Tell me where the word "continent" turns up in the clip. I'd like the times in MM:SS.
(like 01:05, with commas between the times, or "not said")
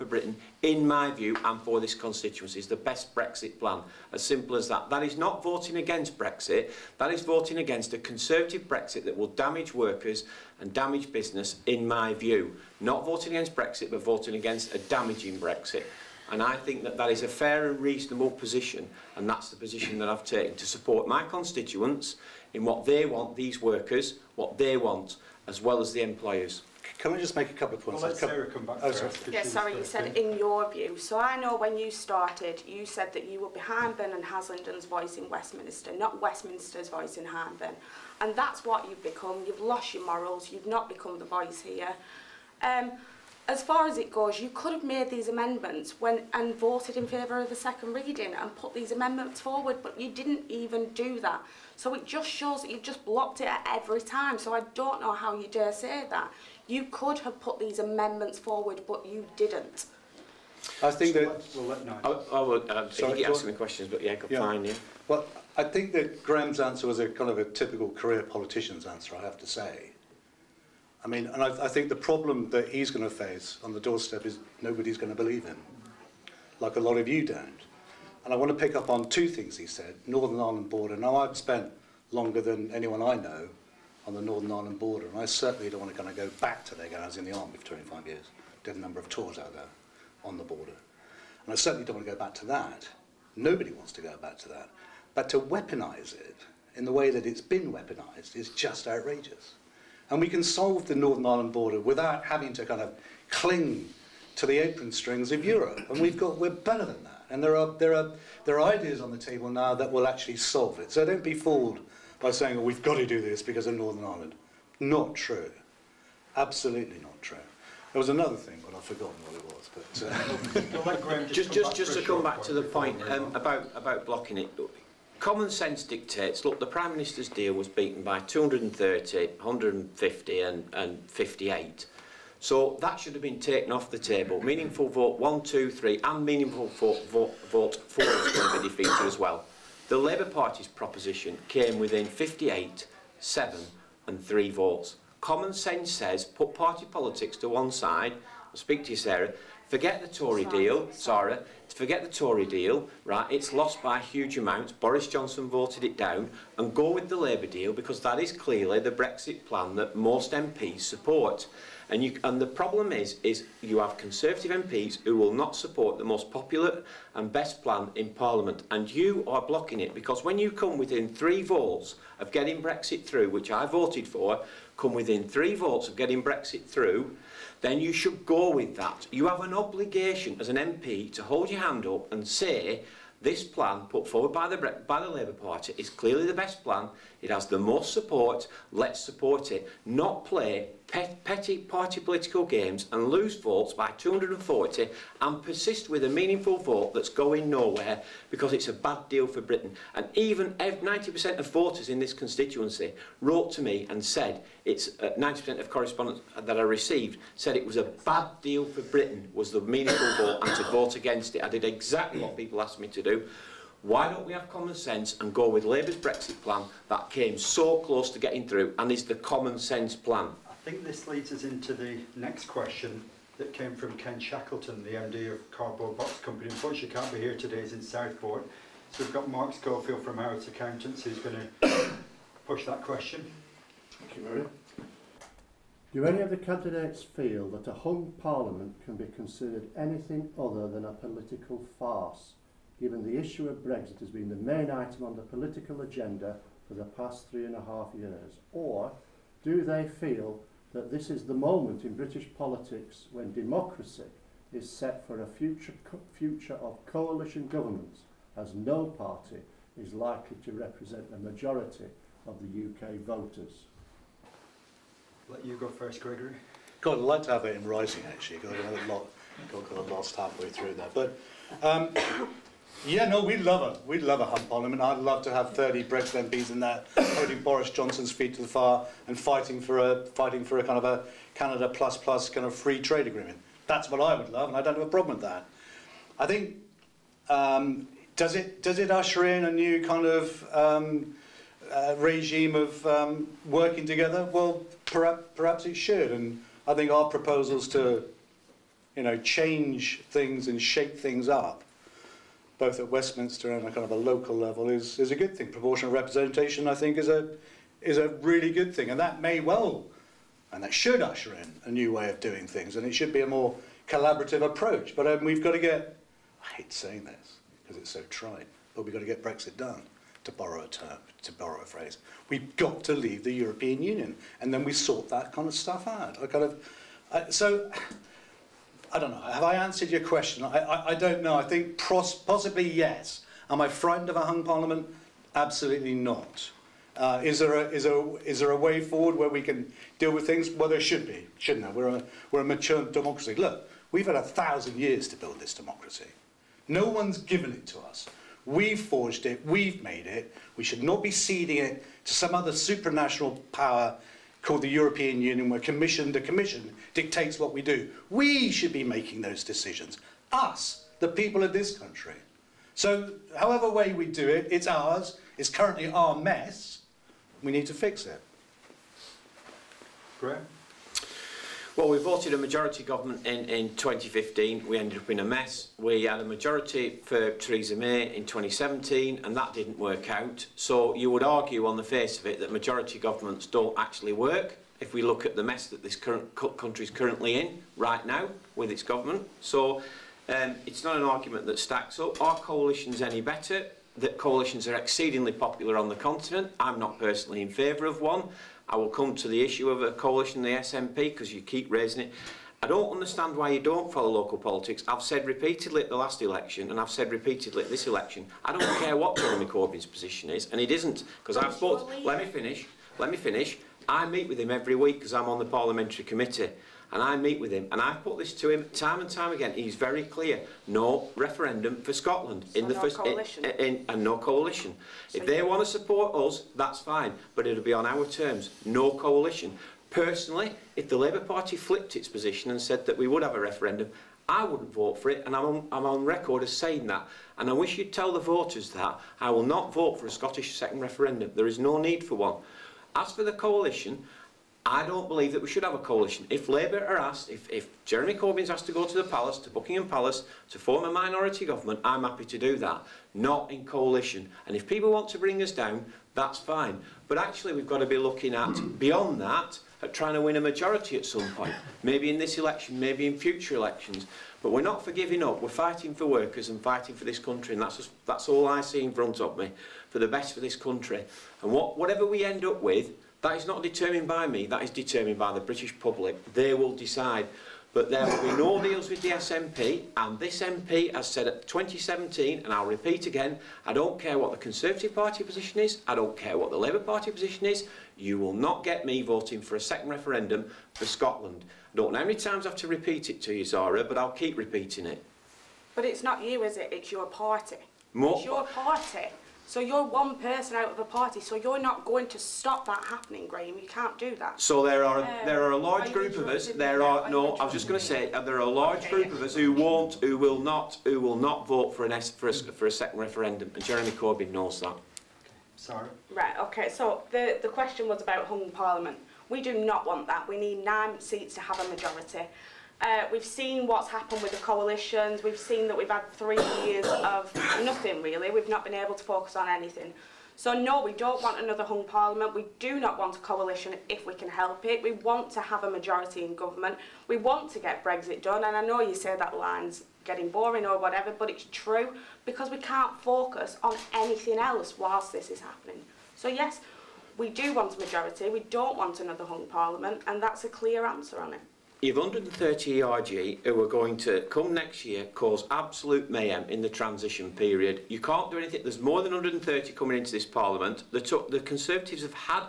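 06:35.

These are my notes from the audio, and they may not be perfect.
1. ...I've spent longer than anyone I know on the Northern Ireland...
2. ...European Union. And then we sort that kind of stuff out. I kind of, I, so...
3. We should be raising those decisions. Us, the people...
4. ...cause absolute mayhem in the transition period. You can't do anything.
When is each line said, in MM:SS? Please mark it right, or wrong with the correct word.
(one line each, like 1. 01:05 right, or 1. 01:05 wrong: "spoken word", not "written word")
1. 01:21 right
2. 05:23 right
3. 05:58 wrong: "making", not "raising"
4. 09:15 right.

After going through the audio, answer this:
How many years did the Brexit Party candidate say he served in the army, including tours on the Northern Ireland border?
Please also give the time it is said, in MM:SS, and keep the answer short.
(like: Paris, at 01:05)
25 years, at 01:27.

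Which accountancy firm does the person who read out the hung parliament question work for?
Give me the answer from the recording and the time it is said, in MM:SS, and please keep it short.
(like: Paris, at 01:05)
Harrods Accountants, at 03:50.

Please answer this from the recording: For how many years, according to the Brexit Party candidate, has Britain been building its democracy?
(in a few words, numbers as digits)
a thousand years.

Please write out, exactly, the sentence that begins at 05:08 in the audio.
And that may well, and that should usher in a new way of doing things.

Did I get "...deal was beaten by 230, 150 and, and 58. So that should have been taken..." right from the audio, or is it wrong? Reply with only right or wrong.
right.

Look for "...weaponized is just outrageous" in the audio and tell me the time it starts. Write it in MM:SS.
01:37.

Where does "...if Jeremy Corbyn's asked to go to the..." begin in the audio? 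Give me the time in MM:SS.
07:27.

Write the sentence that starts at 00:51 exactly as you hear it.
So it just shows that you've just blocked it at every time.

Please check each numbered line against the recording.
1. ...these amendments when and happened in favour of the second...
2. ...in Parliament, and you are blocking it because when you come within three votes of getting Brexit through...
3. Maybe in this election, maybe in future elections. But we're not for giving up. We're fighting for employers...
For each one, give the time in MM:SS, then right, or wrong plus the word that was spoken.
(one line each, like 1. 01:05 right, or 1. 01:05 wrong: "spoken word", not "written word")
1. 00:45 wrong: "voted", not "happened"
2. 02:47 right
3. 07:41 wrong: "workers", not "employers".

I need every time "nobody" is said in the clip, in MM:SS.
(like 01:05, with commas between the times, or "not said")
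01:14, 01:33.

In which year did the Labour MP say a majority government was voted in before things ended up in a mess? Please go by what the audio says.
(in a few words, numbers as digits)
2015.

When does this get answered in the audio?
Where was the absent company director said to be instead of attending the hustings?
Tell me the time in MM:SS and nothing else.
03:47.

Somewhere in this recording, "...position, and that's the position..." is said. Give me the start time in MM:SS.
00:18.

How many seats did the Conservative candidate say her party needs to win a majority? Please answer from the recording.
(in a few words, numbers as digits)
9.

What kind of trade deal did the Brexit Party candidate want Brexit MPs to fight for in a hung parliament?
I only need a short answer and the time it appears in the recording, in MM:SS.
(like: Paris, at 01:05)
Canada plus plus, at 04:41.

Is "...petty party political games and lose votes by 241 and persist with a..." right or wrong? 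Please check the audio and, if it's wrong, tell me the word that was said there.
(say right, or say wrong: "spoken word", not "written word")
wrong: "240", not "241".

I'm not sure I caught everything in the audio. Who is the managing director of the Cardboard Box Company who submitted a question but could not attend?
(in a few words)
Ken Shackleton.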